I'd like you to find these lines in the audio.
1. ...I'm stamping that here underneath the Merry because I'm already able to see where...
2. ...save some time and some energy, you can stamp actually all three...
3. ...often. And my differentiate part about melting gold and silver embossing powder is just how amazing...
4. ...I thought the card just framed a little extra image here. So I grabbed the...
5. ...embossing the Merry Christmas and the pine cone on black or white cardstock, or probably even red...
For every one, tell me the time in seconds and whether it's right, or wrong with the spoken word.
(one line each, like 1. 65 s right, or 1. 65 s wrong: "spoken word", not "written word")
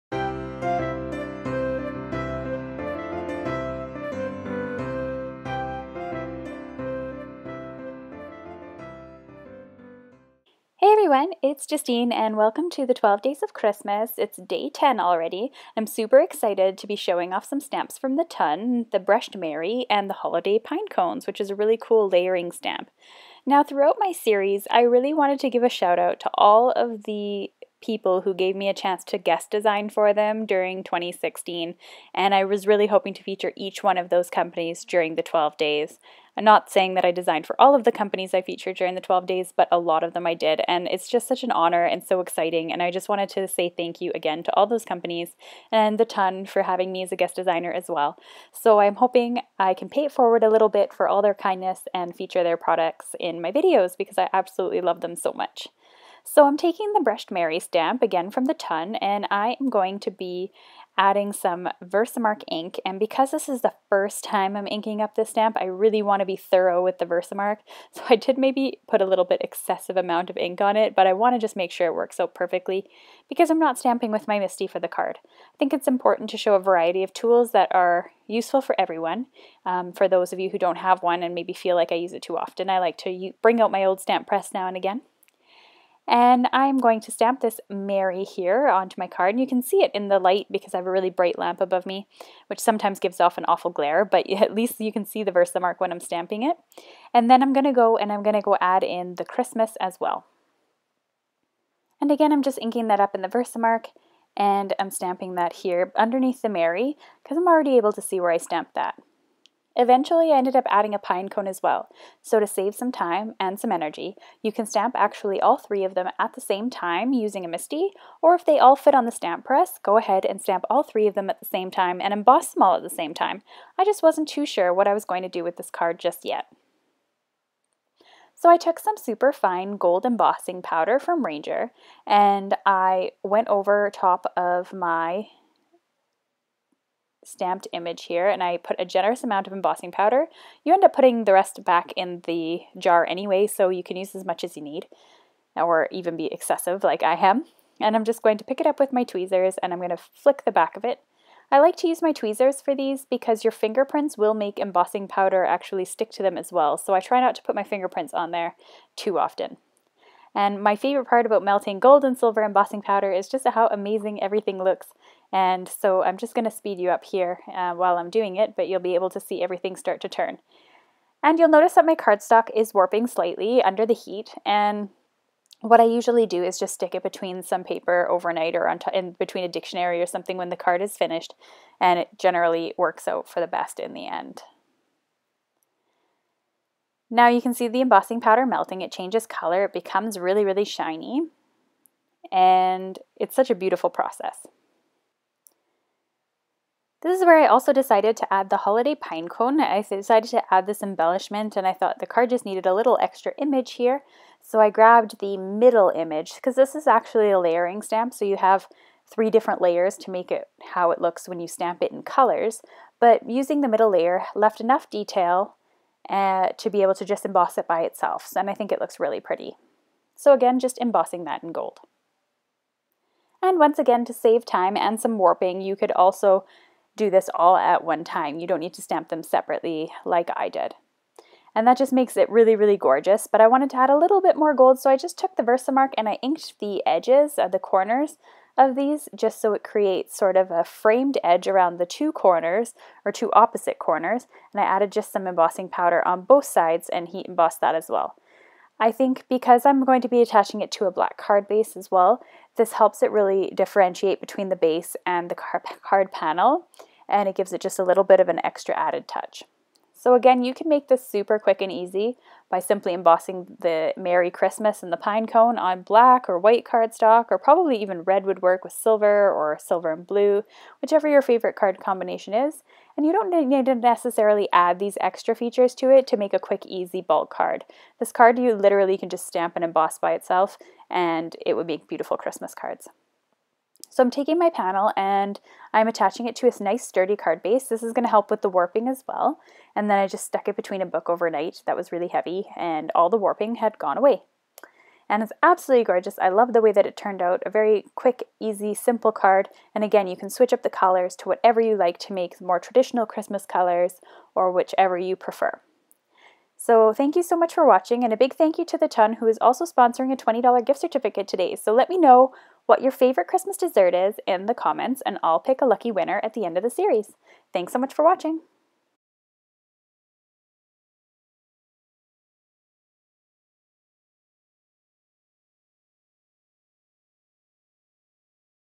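1. 104 s right
2. 112 s right
3. 159 s wrong: "favorite", not "differentiate"
4. 201 s wrong: "needed", not "framed"
5. 262 s right.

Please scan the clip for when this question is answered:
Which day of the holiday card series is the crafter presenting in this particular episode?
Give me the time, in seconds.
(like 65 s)
14 s.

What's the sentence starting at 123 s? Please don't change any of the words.
I just wasn't too sure what I was going to do with this card just yet.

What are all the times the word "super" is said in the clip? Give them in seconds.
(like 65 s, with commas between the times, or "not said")
15 s, 128 s, 261 s.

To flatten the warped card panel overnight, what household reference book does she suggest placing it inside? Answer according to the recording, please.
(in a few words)
A dictionary.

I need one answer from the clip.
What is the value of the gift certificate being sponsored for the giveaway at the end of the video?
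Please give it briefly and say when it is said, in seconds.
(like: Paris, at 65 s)
$20, at 310 s.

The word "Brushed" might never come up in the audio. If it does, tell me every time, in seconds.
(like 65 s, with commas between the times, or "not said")
18 s, 57 s.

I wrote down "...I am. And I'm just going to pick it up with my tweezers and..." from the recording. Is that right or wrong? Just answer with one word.
right.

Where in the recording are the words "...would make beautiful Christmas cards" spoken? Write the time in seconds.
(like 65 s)
281 s.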